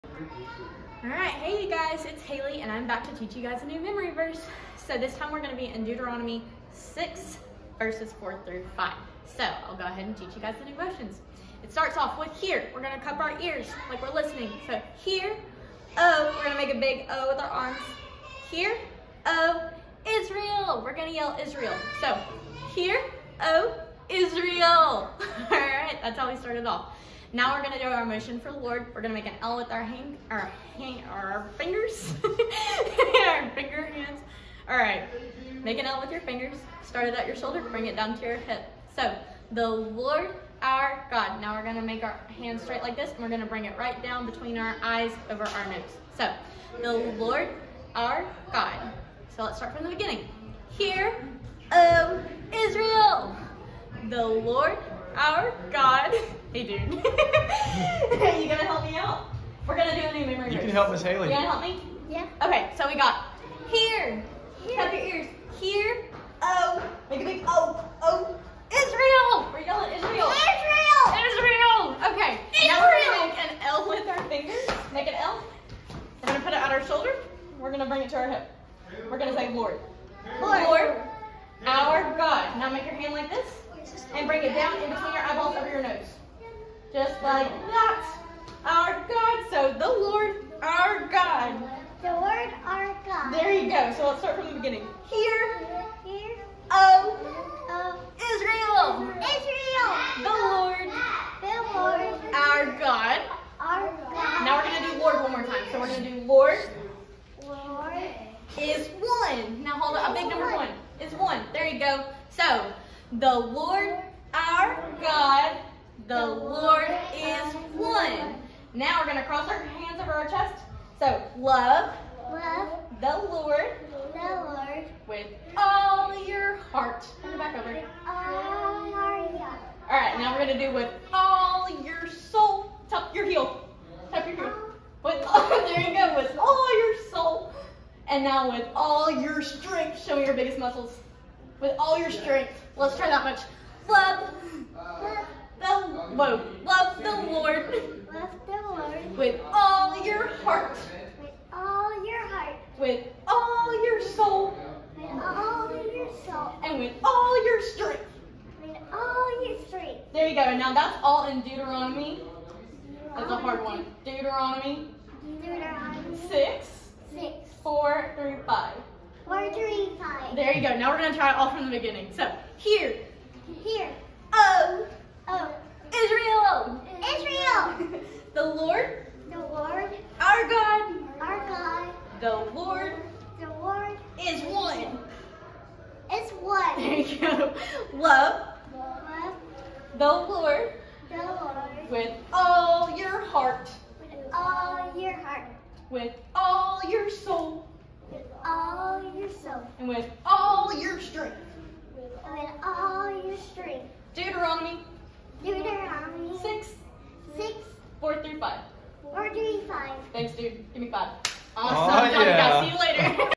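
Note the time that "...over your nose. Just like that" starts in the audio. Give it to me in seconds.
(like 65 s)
85 s.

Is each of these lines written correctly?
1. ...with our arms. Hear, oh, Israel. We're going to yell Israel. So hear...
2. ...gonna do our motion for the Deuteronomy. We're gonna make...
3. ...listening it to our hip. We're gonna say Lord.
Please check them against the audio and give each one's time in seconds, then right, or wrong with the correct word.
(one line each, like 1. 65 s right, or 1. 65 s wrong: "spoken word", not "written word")
1. 17 s right
2. 27 s wrong: "Lord", not "Deuteronomy"
3. 77 s wrong: "bring", not "listening".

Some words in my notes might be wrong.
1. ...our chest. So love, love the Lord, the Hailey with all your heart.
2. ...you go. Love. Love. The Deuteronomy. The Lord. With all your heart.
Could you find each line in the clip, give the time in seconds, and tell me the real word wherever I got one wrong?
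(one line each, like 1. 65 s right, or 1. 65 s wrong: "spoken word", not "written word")
1. 120 s wrong: "Lord", not "Hailey"
2. 186 s wrong: "Lord", not "Deuteronomy".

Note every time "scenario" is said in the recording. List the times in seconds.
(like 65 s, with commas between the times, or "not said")
not said.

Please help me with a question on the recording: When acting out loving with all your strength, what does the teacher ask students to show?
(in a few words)
Biggest muscles.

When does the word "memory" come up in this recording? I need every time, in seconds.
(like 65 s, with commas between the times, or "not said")
3 s, 60 s.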